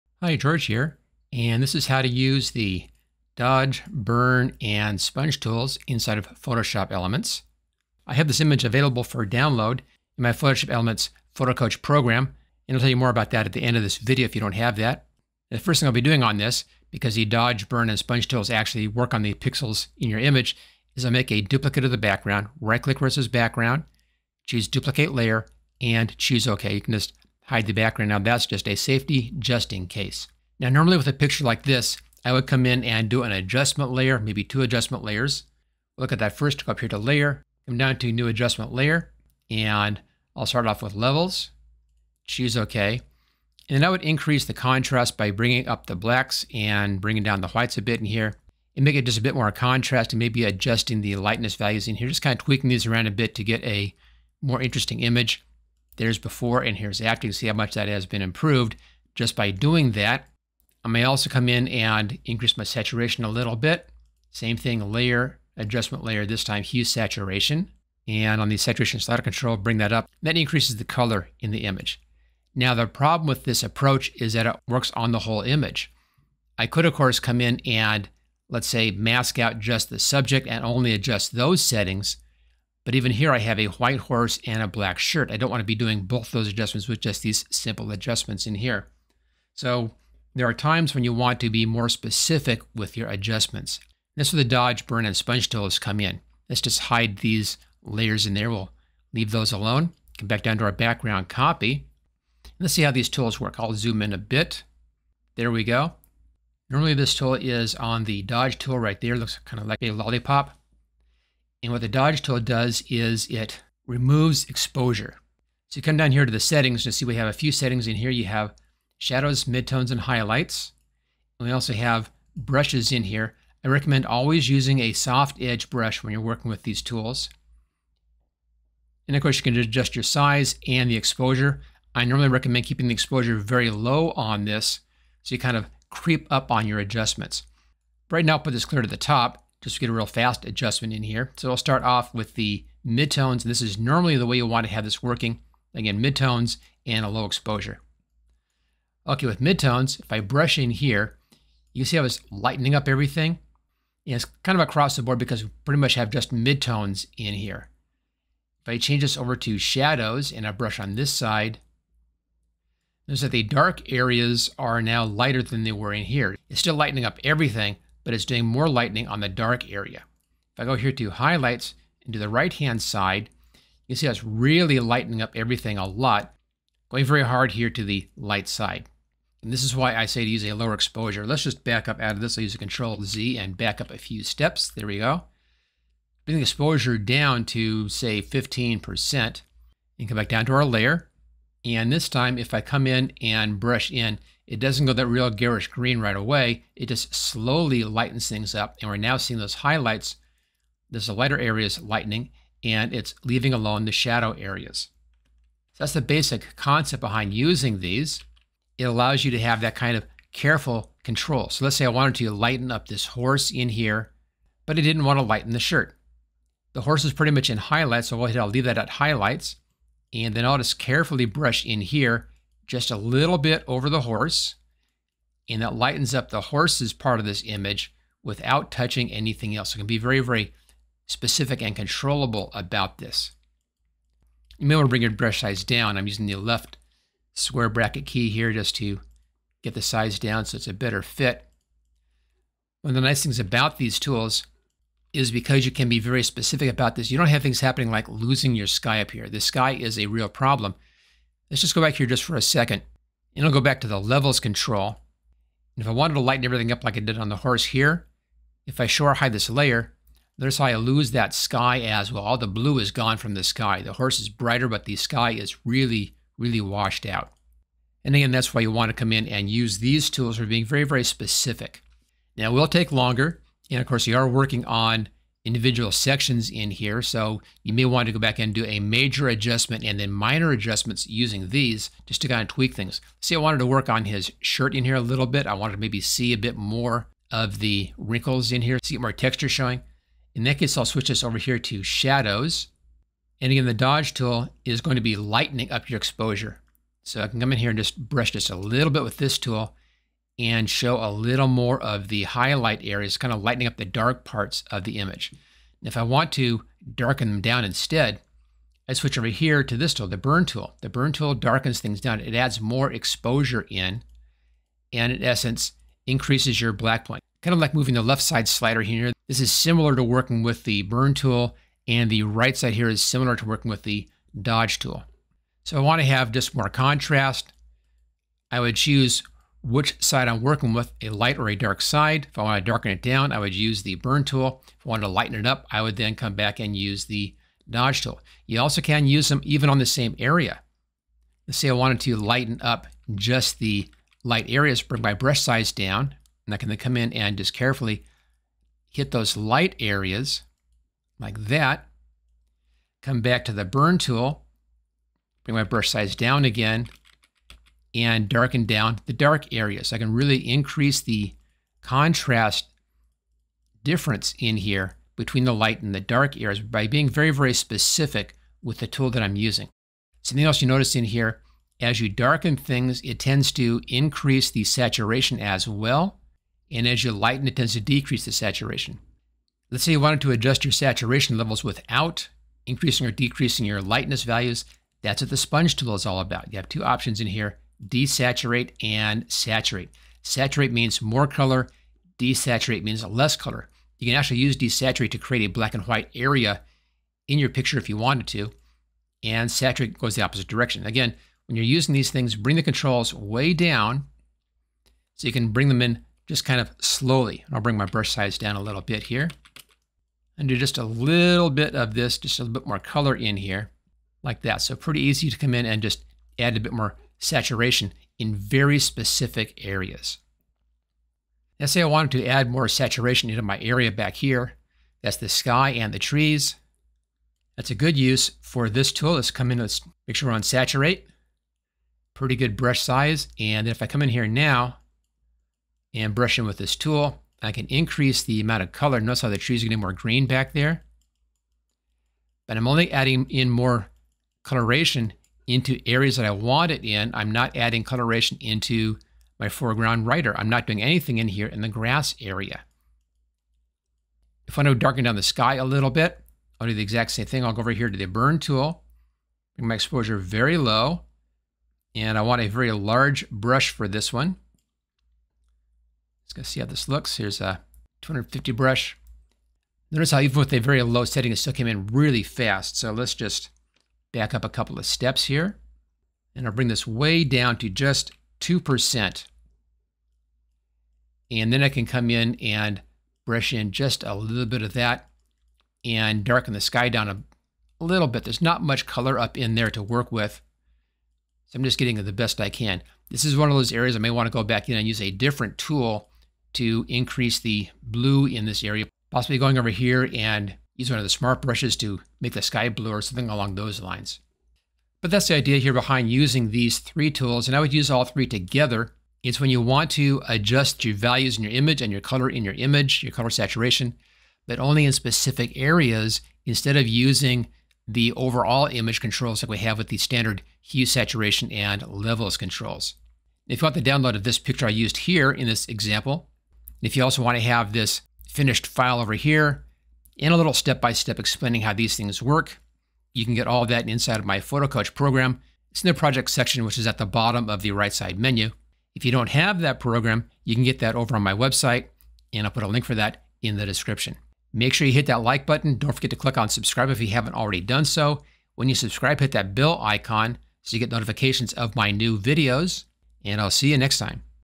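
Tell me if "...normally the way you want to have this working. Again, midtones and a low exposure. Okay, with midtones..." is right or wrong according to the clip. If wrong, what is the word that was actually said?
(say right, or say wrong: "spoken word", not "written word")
right.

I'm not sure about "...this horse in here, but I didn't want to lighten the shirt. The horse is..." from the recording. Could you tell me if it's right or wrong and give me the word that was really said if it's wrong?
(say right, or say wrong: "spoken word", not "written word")
right.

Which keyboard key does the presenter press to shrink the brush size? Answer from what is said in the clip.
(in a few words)
Left square bracket.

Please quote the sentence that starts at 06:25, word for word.
That's what the sponge tool is all about.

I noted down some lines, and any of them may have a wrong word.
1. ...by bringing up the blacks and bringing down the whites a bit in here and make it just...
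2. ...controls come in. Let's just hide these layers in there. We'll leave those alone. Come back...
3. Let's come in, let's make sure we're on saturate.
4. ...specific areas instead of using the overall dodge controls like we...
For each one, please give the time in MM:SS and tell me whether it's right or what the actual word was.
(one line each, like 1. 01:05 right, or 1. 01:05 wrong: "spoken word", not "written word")
1. 00:45 right
2. 01:35 wrong: "tools", not "controls"
3. 07:09 right
4. 08:34 wrong: "image", not "dodge".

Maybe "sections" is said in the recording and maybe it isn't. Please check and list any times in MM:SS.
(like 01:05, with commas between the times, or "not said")
04:35, 08:56.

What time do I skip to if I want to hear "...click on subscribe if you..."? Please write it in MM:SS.
09:06.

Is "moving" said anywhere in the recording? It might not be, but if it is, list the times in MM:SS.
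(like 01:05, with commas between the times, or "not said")
05:17.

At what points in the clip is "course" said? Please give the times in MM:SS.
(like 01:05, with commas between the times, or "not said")
01:16, 02:09, 04:33.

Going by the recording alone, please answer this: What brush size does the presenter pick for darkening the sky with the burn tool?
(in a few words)
250.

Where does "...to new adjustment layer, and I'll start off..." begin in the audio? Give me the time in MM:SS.
00:37.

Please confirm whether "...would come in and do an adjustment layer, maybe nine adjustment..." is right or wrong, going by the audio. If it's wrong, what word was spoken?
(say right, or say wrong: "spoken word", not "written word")
wrong: "two", not "nine".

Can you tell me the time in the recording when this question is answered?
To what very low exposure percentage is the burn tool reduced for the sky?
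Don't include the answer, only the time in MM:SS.
07:58.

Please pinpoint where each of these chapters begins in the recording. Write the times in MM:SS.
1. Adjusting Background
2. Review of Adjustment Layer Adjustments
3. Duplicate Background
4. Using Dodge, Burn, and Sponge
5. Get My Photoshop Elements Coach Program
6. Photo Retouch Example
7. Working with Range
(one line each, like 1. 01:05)
1. 07:00
2. 00:35
3. 00:15
4. 01:41
5. 08:43
6. 03:28
7. 01:55.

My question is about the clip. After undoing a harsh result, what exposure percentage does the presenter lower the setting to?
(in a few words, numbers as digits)
15%.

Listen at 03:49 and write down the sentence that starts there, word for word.
So it can be very, very specific and controllable about this.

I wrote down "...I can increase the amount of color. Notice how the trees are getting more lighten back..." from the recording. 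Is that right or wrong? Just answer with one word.
wrong.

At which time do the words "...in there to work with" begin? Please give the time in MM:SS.
08:09.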